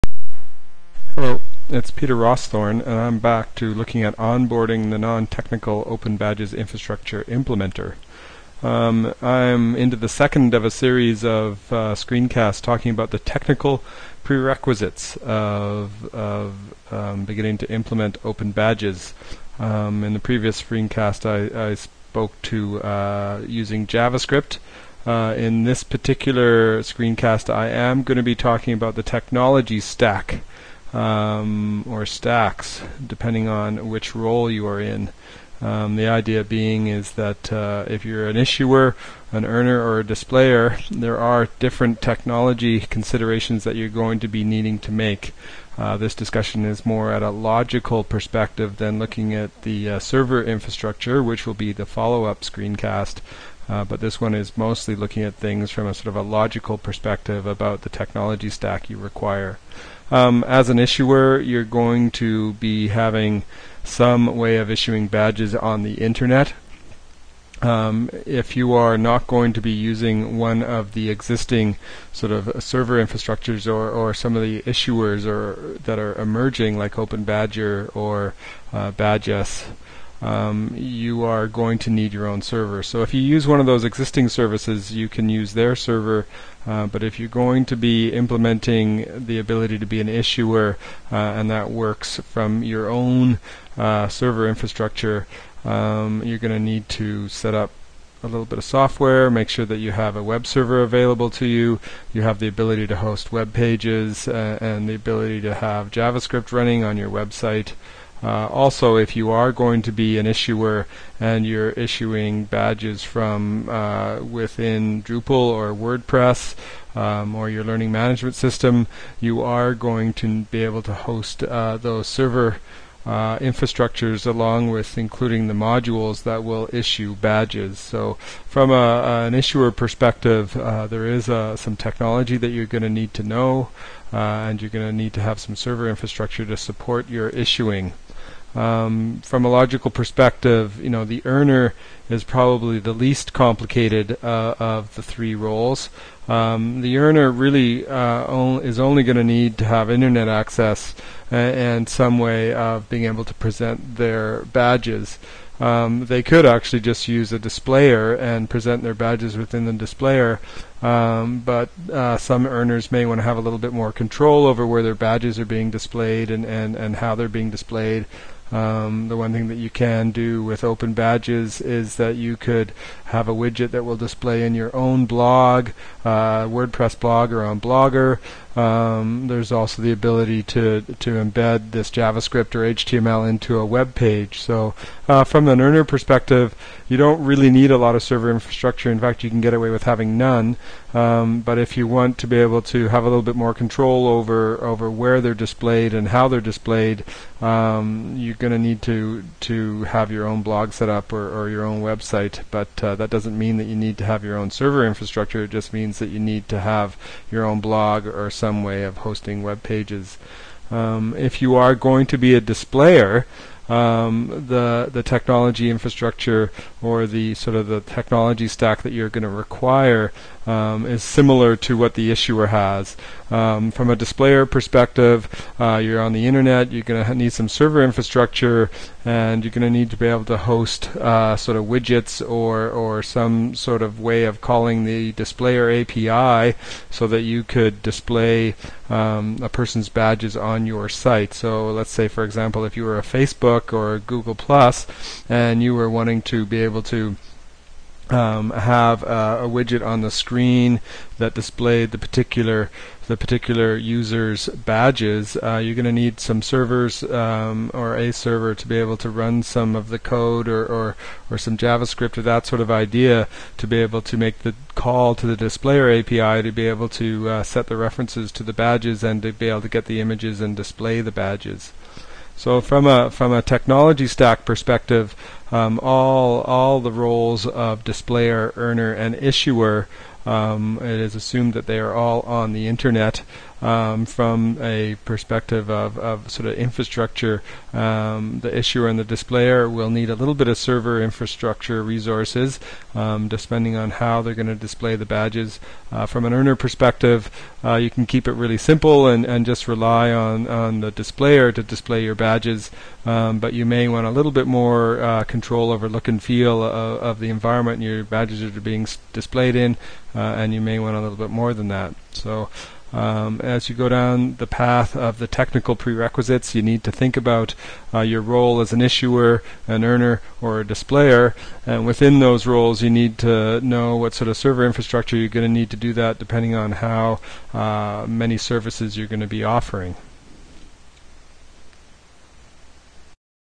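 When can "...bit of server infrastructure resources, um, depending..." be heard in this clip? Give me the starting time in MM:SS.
04:50.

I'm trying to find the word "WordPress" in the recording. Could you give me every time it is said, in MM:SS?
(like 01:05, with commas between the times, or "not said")
01:55, 02:56.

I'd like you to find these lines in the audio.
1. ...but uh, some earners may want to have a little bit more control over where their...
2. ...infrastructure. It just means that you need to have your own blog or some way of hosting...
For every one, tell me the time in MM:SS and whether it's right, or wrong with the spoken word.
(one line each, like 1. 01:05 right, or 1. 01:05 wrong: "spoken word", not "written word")
1. 02:41 right
2. 03:24 right.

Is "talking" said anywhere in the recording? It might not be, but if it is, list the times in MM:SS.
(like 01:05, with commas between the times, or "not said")
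00:12, 00:28.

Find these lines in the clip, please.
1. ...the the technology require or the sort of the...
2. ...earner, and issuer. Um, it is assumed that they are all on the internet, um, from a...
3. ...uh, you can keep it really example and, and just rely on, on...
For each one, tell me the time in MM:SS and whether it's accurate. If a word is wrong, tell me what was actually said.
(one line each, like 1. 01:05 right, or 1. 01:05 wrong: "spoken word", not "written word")
1. 03:34 wrong: "infrastructure", not "require"
2. 04:38 right
3. 04:57 wrong: "simple", not "example".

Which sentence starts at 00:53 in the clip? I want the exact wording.
Uh, but this one is mostly looking at things from a sort of a logical perspective about the technology stack you require.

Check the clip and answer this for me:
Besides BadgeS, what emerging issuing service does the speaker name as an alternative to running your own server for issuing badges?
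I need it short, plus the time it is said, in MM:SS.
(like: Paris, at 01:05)
OpenBadger, at 01:16.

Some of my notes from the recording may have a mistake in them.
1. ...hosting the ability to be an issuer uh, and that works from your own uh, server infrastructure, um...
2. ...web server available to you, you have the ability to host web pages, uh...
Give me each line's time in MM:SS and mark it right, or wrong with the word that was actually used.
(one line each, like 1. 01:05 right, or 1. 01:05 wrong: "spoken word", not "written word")
1. 01:28 wrong: "implementing", not "hosting"
2. 01:40 right.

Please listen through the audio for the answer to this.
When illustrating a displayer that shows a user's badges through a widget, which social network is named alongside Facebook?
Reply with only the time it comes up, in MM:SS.
04:03.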